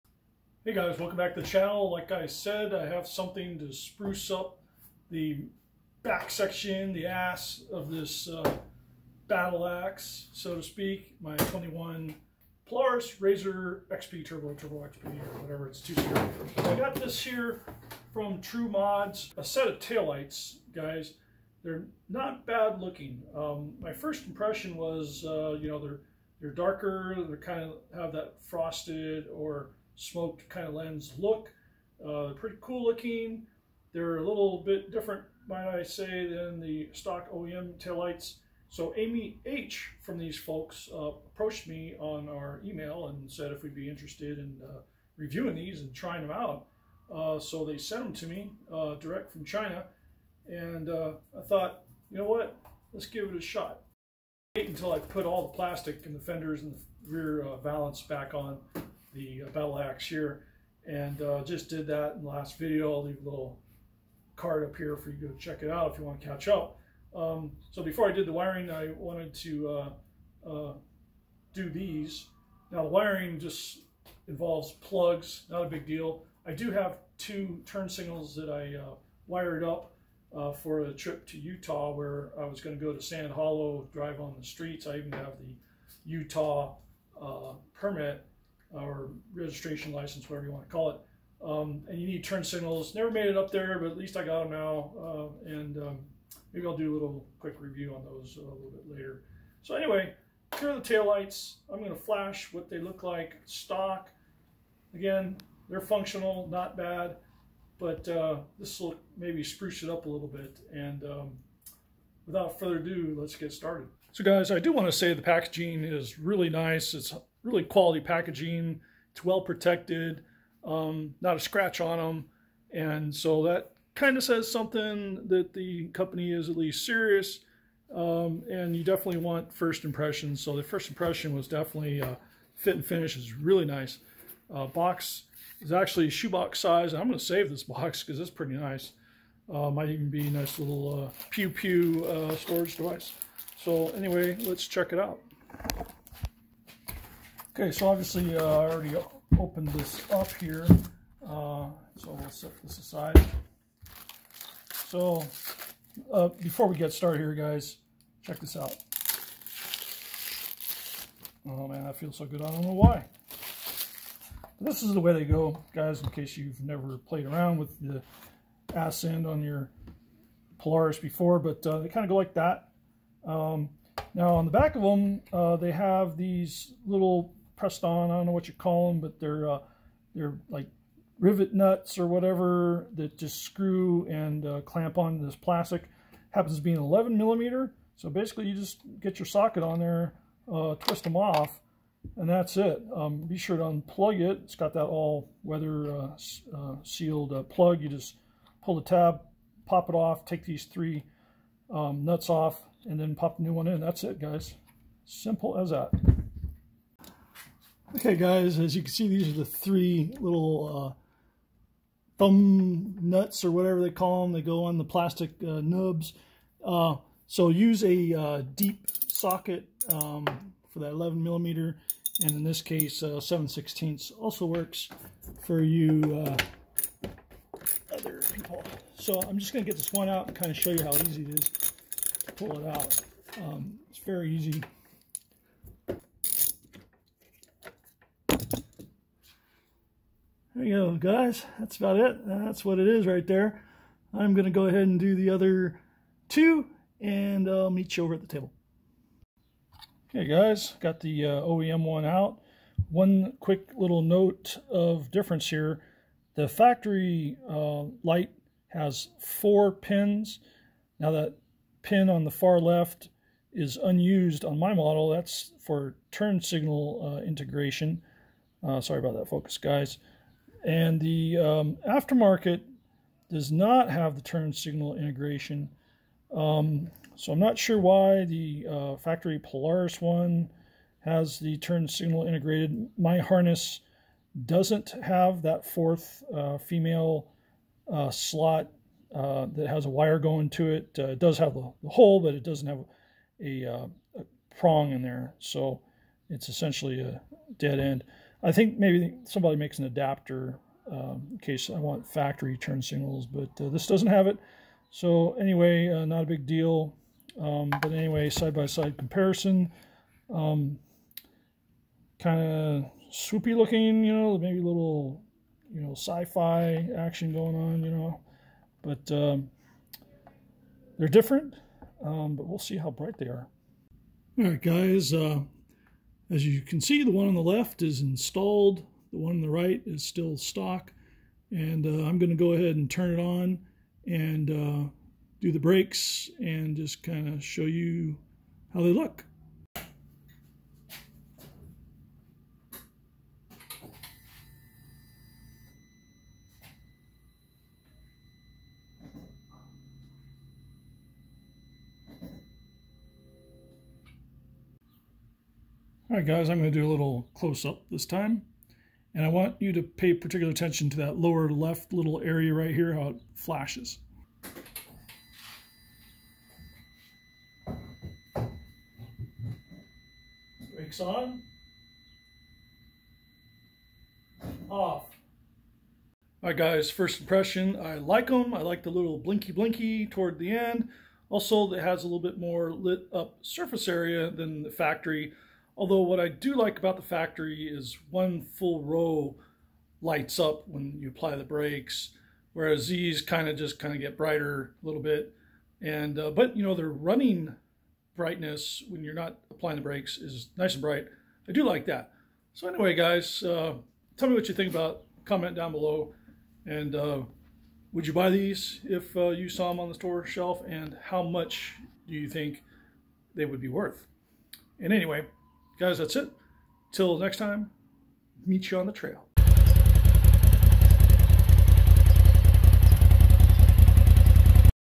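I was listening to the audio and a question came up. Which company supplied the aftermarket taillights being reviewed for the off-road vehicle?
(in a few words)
True Mods.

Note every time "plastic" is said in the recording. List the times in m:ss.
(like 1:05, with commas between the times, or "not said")
0:55, 3:05, 3:34.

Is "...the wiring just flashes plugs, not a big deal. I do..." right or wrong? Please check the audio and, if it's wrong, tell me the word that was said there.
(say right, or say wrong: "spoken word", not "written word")
wrong: "involves", not "flashes".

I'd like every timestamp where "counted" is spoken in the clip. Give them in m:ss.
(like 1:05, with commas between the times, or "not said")
not said.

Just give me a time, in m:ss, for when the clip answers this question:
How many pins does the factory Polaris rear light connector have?
4:19.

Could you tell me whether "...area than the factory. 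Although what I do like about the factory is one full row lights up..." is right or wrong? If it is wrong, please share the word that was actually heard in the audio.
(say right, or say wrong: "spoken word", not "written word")
right.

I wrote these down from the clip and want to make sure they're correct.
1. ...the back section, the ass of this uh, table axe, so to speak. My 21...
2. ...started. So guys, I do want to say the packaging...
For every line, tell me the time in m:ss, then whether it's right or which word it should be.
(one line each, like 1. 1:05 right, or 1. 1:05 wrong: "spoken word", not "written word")
1. 0:05 wrong: "battle", not "table"
2. 1:53 right.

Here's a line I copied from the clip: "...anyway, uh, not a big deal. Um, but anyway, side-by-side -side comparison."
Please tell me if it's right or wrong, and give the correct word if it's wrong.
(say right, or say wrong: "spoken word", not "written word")
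right.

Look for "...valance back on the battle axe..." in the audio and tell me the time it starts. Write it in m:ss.
0:57.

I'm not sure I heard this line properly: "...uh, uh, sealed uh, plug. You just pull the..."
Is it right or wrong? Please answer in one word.
right.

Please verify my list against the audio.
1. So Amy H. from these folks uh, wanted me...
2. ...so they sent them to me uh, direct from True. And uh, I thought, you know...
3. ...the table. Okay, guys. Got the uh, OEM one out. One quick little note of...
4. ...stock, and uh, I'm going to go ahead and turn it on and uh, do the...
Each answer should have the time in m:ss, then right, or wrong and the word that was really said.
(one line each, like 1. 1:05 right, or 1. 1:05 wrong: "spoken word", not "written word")
1. 0:38 wrong: "approached", not "wanted"
2. 0:47 wrong: "China", not "True"
3. 4:08 right
4. 5:30 right.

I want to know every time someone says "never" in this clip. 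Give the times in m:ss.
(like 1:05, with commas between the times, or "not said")
1:32, 2:46.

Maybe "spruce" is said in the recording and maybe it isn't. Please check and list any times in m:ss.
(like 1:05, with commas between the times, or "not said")
0:03, 1:49.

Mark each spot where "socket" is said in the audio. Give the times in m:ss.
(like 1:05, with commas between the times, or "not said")
3:09, 3:39.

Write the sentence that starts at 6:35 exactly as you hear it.
And uh, but you know the running brightness when you're not applying the brakes is nice and bright.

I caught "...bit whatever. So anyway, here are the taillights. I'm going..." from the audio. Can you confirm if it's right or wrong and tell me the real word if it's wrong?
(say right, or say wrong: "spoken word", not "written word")
wrong: "later", not "whatever".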